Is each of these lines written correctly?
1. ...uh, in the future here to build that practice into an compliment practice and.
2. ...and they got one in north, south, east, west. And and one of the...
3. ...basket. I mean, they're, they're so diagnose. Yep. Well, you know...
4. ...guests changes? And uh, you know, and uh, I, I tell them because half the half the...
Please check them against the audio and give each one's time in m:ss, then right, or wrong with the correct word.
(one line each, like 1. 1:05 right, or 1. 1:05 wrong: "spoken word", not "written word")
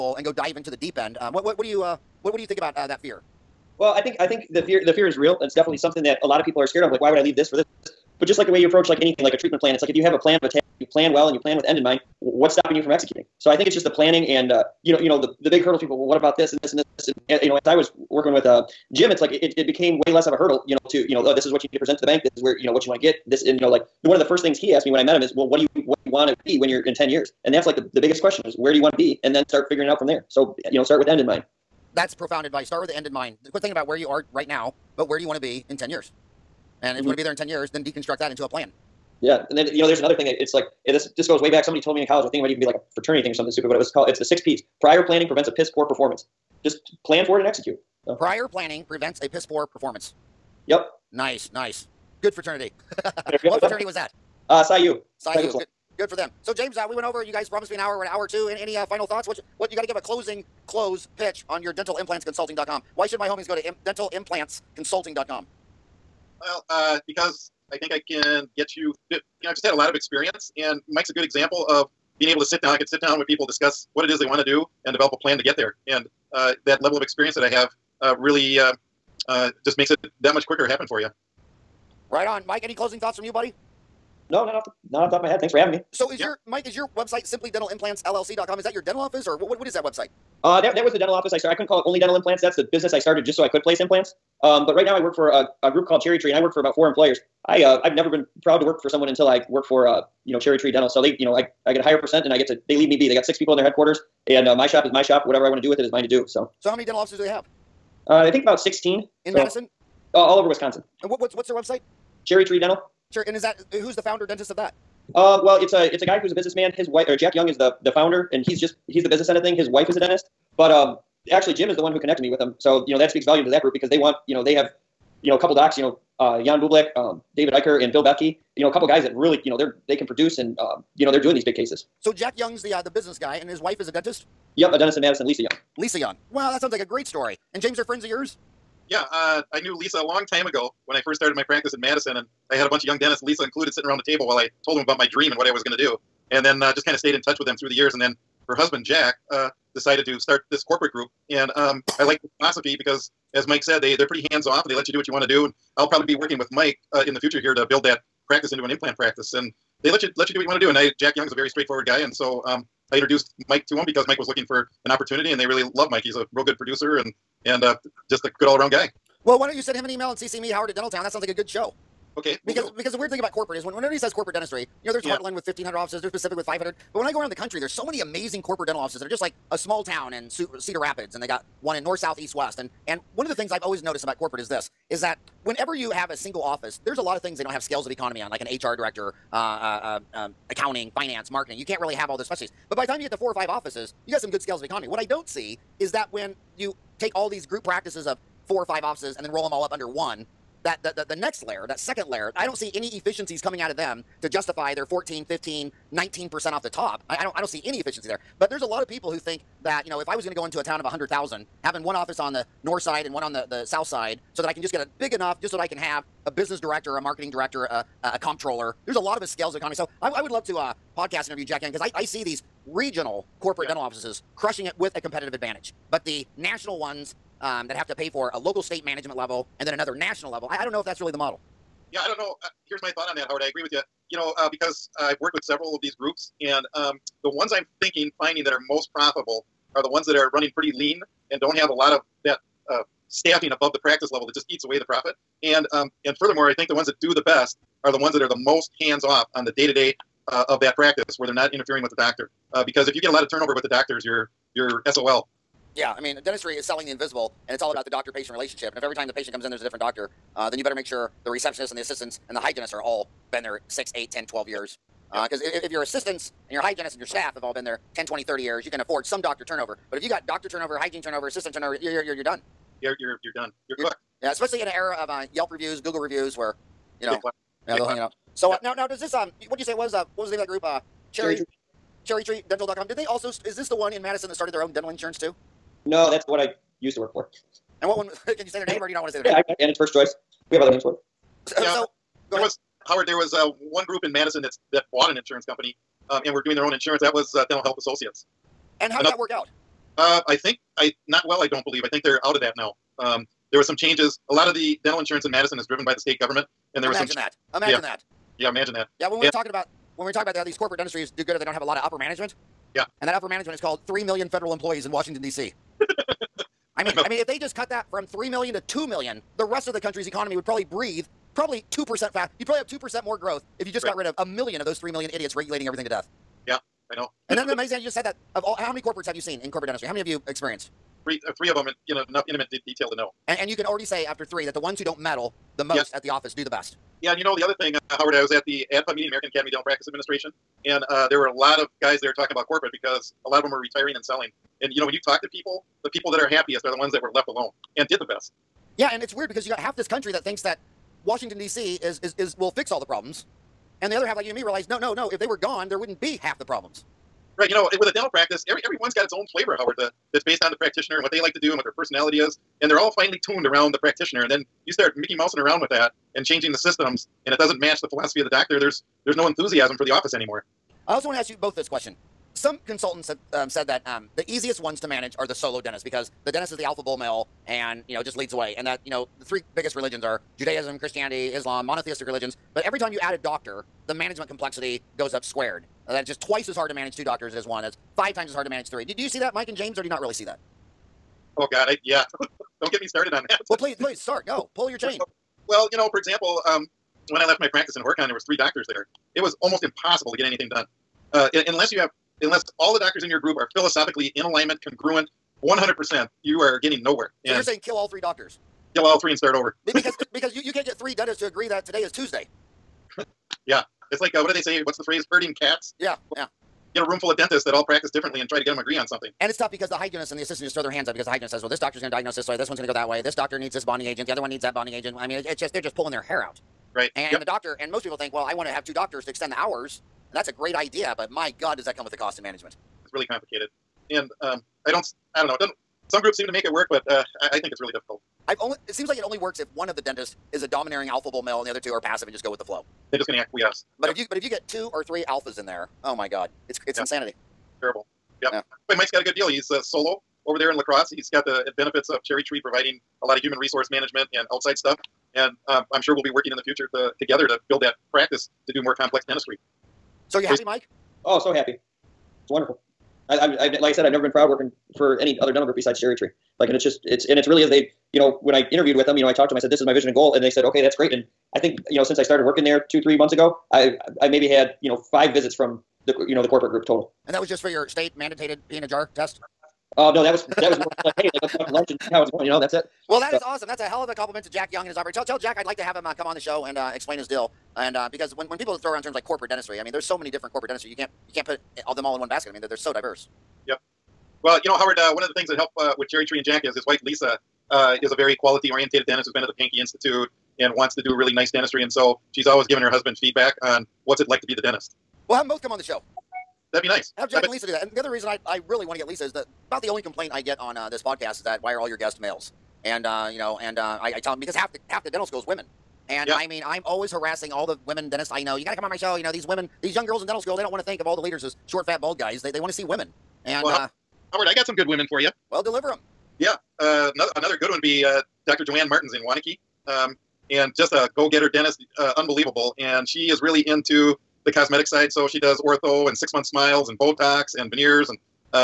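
1. 2:36 wrong: "implant", not "compliment"
2. 3:01 right
3. 8:12 wrong: "diverse", not "diagnose"
4. 8:31 wrong: "males", not "changes".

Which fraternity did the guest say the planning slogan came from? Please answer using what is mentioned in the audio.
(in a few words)
Psi U.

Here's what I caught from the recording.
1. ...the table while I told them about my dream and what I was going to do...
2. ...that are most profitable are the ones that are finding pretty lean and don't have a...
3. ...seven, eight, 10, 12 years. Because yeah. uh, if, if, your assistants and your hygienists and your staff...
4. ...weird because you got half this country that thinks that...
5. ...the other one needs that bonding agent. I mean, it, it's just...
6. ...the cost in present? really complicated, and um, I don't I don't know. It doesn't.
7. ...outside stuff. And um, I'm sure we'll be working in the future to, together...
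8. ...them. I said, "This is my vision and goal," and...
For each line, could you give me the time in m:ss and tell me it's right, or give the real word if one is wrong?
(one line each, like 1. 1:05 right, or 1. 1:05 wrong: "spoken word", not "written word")
1. 2:23 right
2. 3:58 wrong: "running", not "finding"
3. 4:23 wrong: "six", not "seven"
4. 5:49 right
5. 7:04 right
6. 7:11 wrong: "management", not "present"
7. 7:34 right
8. 7:49 right.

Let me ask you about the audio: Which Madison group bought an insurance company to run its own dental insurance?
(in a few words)
Dental Health Associates.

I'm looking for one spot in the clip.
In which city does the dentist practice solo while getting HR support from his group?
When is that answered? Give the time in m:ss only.
7:30.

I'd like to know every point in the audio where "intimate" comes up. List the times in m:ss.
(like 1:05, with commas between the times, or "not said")
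5:32.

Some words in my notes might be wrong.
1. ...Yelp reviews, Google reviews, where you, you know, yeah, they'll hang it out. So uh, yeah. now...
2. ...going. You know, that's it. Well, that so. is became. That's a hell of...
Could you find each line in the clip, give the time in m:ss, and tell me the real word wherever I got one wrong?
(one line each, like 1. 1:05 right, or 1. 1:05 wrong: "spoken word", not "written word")
1. 4:35 right
2. 8:02 wrong: "awesome", not "became".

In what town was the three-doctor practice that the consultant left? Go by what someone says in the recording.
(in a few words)
Horicon.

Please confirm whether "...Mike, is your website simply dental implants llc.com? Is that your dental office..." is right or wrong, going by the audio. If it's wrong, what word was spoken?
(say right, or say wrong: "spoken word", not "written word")
right.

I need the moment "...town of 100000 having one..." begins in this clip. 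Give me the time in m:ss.
3:30.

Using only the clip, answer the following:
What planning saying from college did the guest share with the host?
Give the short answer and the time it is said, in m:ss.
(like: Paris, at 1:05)
six P's, at 0:44.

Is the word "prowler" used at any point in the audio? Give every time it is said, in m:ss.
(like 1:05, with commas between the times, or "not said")
not said.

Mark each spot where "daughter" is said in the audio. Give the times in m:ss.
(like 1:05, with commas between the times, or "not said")
not said.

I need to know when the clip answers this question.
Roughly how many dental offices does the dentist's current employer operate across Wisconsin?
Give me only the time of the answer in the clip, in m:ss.
1:48.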